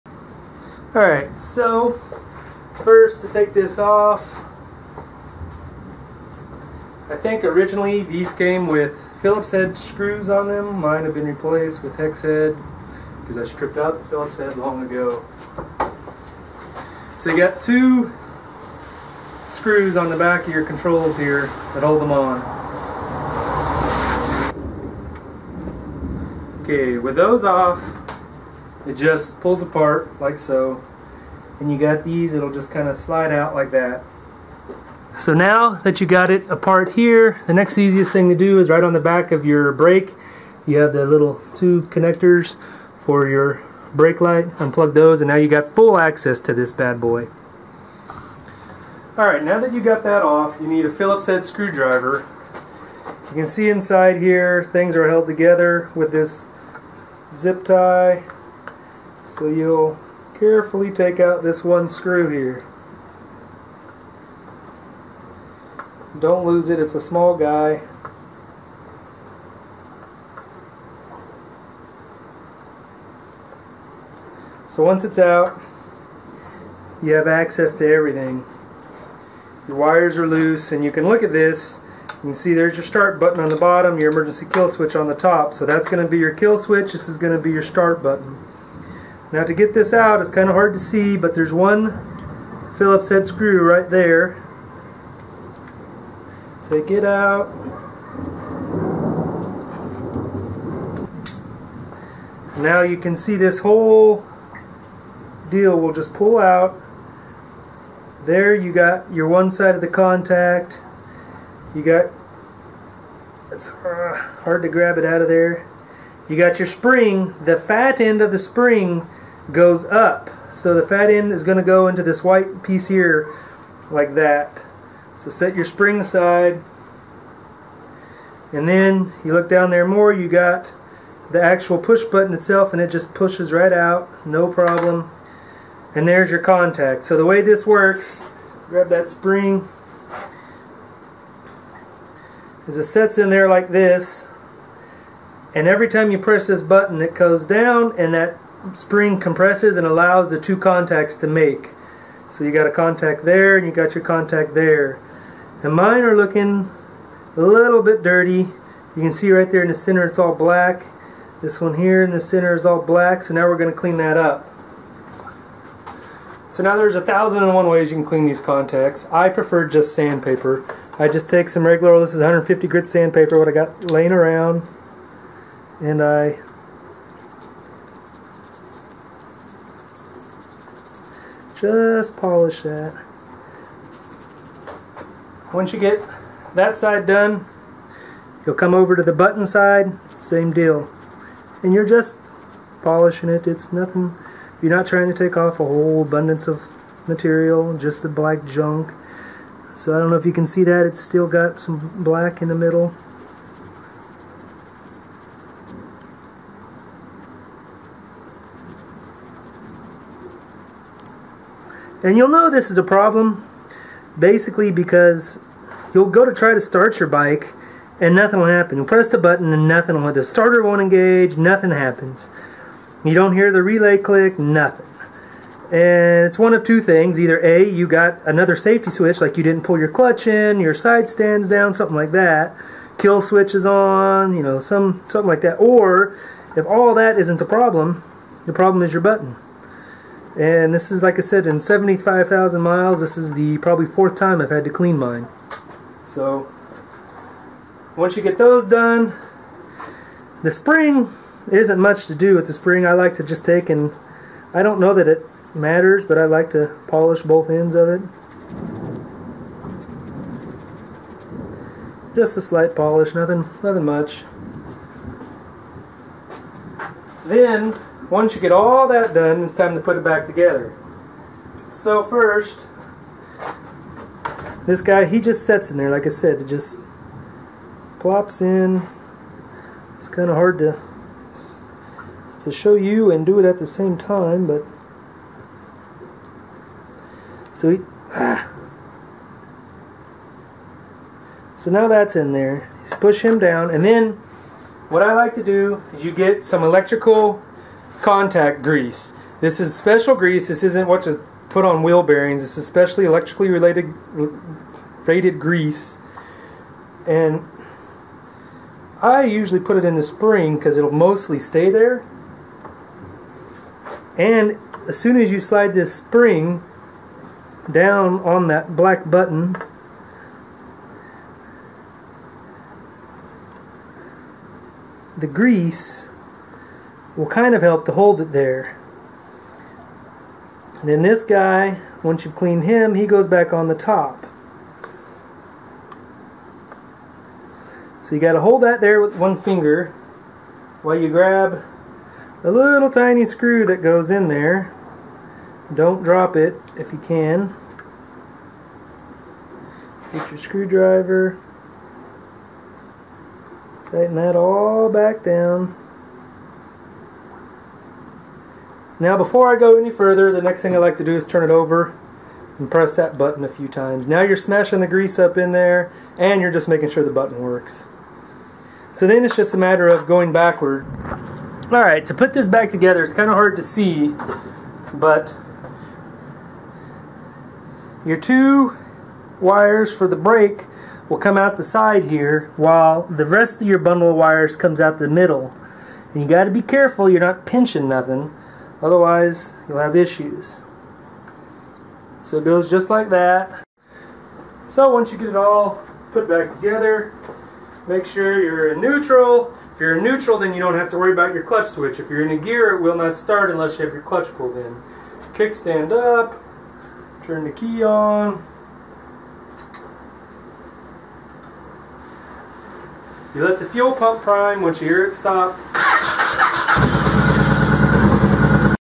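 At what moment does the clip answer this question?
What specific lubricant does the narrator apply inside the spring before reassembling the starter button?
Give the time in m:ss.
4:56.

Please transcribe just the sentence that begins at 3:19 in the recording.
So I don't know if you can see that, it's still got some black in the middle.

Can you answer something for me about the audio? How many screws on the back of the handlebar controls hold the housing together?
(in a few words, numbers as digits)
2.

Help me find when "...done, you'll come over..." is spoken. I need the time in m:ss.
3:07.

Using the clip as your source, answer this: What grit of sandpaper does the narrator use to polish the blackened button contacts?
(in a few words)
150.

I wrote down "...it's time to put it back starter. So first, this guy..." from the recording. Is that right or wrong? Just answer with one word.
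wrong.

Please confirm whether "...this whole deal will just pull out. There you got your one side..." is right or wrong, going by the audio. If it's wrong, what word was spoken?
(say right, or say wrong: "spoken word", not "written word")
right.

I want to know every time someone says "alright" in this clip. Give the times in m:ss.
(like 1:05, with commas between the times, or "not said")
0:00, 0:49, 6:11.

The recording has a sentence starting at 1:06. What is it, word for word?
Don't lose it, it's a small guy.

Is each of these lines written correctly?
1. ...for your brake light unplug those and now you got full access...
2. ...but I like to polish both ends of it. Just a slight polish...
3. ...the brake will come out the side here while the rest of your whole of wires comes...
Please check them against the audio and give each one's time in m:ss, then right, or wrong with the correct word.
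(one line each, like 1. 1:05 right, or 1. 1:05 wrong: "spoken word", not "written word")
1. 0:43 right
2. 4:16 right
3. 6:20 wrong: "bundle", not "whole".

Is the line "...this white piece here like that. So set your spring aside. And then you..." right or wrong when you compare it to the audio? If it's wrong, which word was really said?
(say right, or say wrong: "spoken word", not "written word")
right.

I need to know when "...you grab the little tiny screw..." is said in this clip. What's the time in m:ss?
5:40.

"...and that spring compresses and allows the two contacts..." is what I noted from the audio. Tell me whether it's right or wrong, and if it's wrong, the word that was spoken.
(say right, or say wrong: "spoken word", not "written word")
right.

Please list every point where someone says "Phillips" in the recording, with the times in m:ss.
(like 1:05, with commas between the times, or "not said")
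0:09, 0:14, 0:50, 1:32.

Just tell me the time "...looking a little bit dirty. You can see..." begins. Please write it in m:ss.
2:36.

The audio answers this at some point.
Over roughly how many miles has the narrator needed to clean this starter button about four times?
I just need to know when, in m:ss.
4:01.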